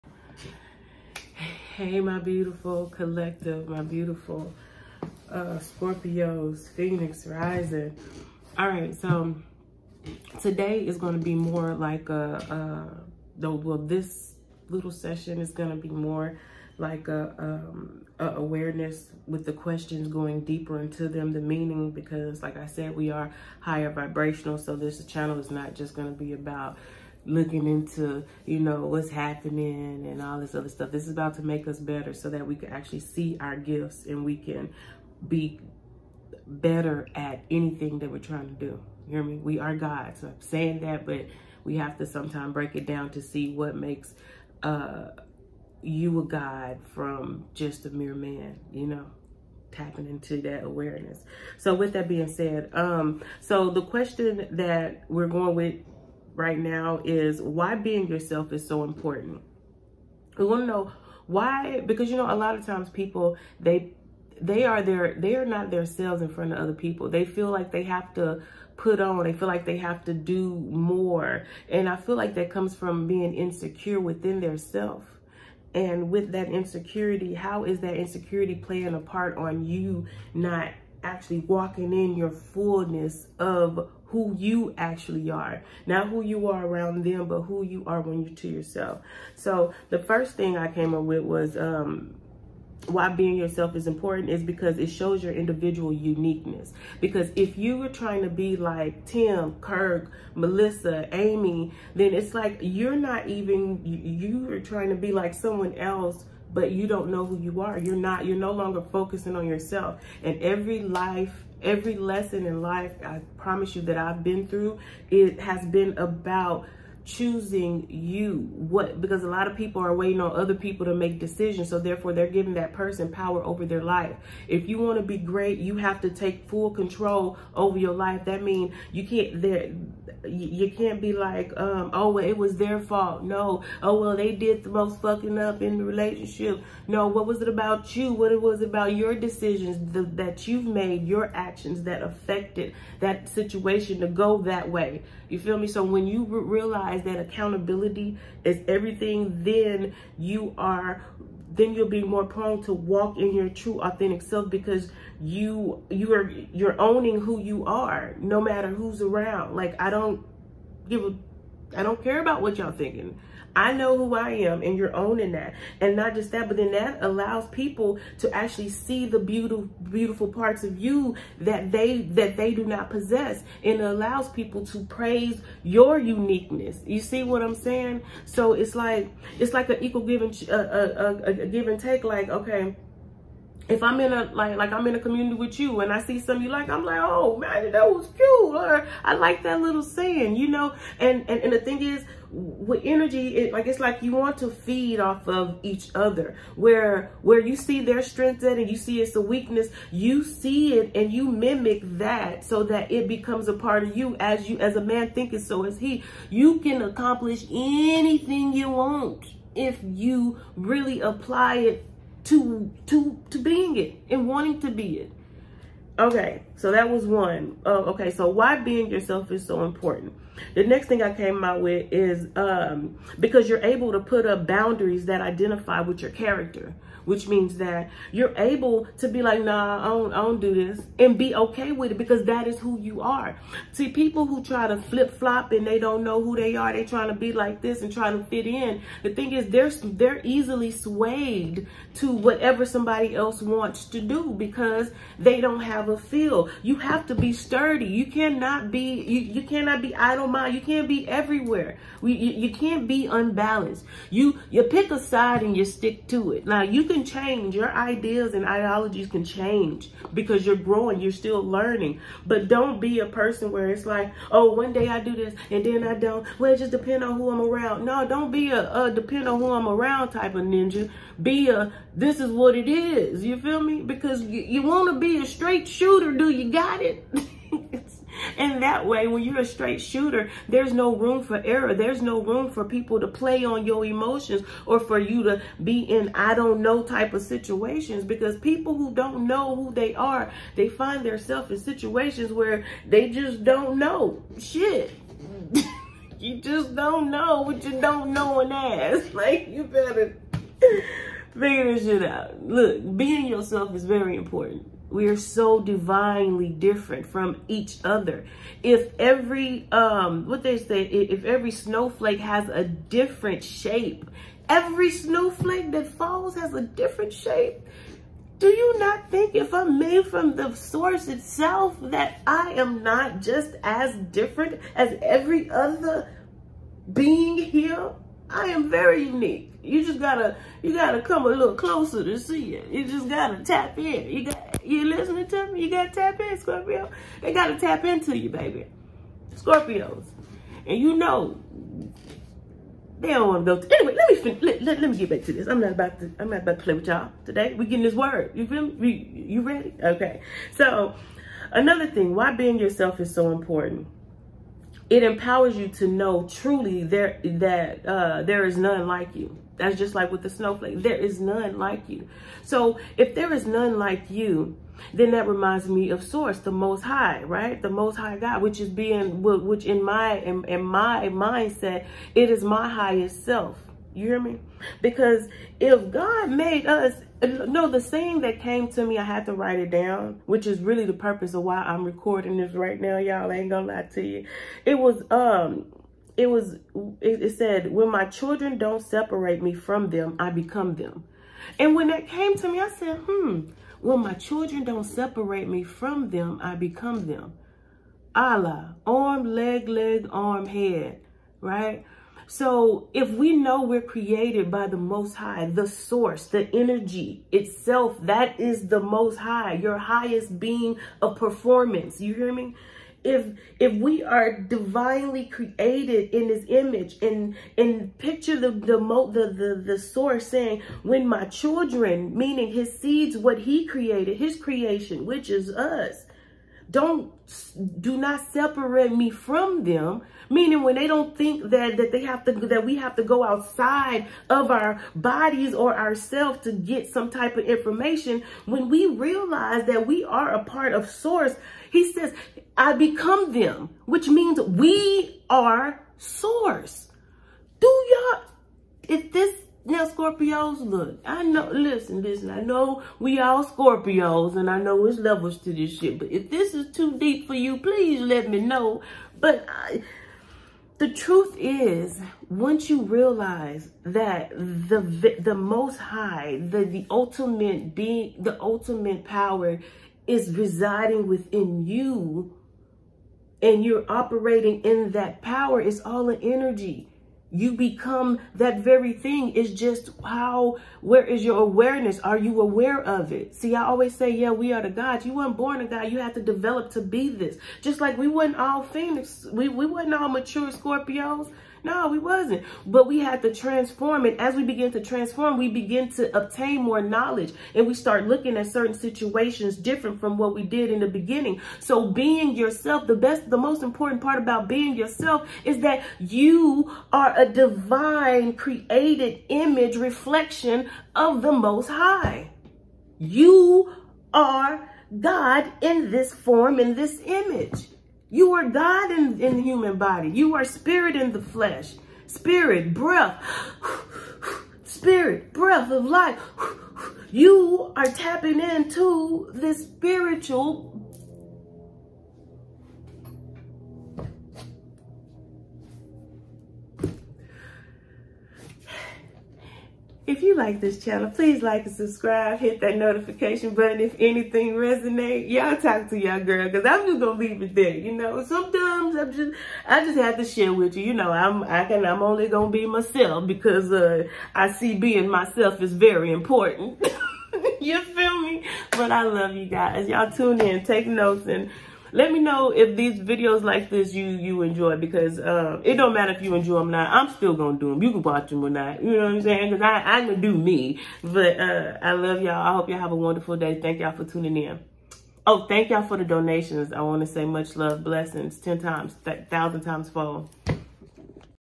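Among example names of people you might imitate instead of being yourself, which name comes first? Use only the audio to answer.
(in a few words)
Tim.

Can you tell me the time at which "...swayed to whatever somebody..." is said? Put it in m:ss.
4:00.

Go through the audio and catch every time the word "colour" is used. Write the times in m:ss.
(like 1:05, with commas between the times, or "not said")
not said.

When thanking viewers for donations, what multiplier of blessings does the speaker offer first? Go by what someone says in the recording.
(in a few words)
Ten times.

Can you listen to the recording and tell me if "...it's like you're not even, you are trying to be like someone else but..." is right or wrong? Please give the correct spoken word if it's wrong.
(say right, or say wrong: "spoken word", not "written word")
right.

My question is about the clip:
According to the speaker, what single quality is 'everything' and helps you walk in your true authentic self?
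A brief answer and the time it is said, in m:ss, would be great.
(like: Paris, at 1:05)
Accountability, at 2:27.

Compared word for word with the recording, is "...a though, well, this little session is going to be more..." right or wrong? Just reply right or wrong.
right.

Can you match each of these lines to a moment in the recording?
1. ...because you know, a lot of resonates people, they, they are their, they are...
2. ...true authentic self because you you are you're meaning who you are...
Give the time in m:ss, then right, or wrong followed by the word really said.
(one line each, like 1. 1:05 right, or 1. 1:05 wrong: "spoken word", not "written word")
1. 1:01 wrong: "times", not "resonates"
2. 2:33 wrong: "owning", not "meaning".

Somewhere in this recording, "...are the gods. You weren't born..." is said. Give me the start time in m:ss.
8:04.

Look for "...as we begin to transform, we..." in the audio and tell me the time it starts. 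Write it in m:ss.
8:14.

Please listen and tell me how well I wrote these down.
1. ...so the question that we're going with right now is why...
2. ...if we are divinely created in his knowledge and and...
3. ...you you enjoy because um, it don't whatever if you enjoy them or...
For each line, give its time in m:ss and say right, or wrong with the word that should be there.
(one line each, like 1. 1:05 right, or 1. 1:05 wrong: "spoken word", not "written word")
1. 0:53 right
2. 6:53 wrong: "image", not "knowledge"
3. 9:23 wrong: "matter", not "whatever".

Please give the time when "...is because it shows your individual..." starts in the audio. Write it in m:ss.
1:34.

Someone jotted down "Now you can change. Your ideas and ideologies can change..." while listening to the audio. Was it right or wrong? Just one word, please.
right.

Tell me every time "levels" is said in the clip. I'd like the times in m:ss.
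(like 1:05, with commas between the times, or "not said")
7:34.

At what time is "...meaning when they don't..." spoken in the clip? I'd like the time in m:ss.
7:10.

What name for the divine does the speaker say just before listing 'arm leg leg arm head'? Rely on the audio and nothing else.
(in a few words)
Allah.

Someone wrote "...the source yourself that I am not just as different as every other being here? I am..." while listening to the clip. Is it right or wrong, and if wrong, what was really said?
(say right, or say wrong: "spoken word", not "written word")
wrong: "itself", not "yourself".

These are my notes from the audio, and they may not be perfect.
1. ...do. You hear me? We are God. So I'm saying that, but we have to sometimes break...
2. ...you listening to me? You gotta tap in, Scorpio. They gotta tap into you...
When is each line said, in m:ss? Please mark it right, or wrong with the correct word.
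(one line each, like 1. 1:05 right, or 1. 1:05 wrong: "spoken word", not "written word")
1. 0:38 right
2. 5:34 right.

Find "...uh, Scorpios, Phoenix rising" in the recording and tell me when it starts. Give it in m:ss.
0:05.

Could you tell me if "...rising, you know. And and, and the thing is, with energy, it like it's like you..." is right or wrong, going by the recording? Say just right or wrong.
wrong.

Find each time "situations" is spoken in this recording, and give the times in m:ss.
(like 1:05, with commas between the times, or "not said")
2:23, 4:47, 4:51, 8:18.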